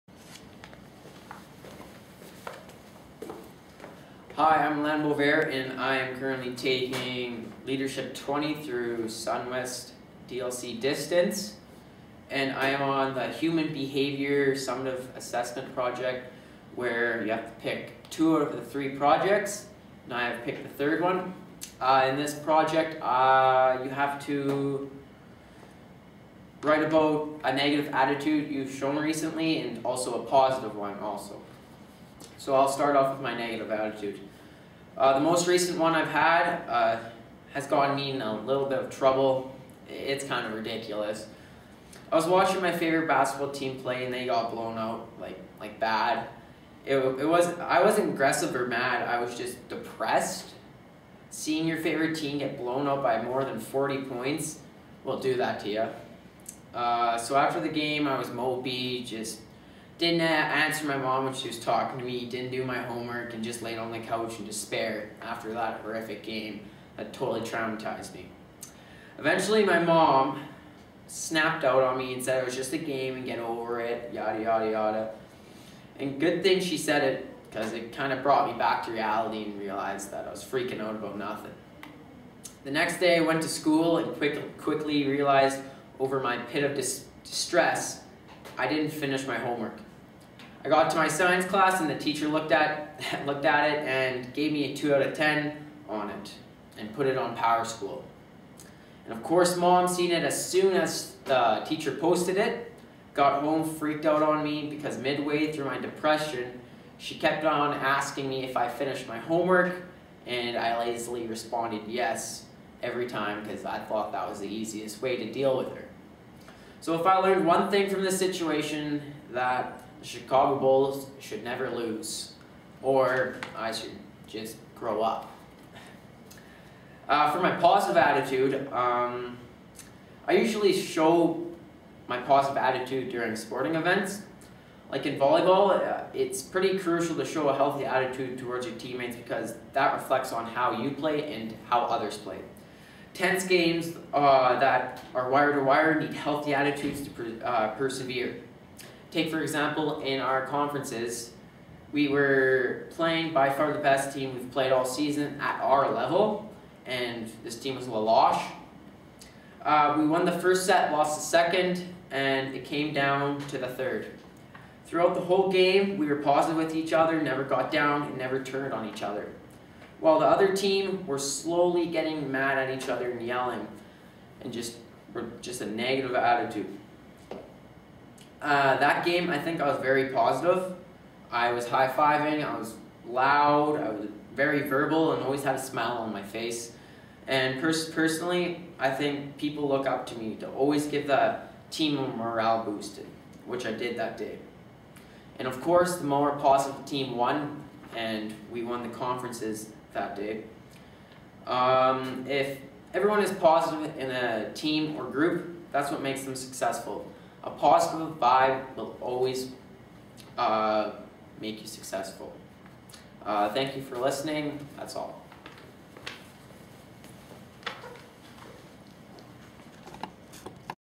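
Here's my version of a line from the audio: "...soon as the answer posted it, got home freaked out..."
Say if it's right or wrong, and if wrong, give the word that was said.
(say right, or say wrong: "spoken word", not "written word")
wrong: "teacher", not "answer".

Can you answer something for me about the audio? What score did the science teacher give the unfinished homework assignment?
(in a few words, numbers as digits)
2 out of 10.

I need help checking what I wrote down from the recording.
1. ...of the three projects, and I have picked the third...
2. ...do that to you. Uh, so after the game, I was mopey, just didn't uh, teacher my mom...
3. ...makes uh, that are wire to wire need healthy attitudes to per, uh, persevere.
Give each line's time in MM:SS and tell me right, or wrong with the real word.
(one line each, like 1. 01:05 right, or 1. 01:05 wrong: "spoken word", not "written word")
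1. 00:18 right
2. 00:55 wrong: "answer", not "teacher"
3. 02:23 wrong: "games", not "makes".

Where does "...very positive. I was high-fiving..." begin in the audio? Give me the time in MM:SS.
02:59.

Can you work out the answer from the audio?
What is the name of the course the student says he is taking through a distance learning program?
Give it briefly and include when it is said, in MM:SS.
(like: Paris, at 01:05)
Leadership 20, at 00:07.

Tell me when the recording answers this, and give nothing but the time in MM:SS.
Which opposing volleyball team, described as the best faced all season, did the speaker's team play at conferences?
02:37.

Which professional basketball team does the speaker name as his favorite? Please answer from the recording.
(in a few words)
Chicago Bulls.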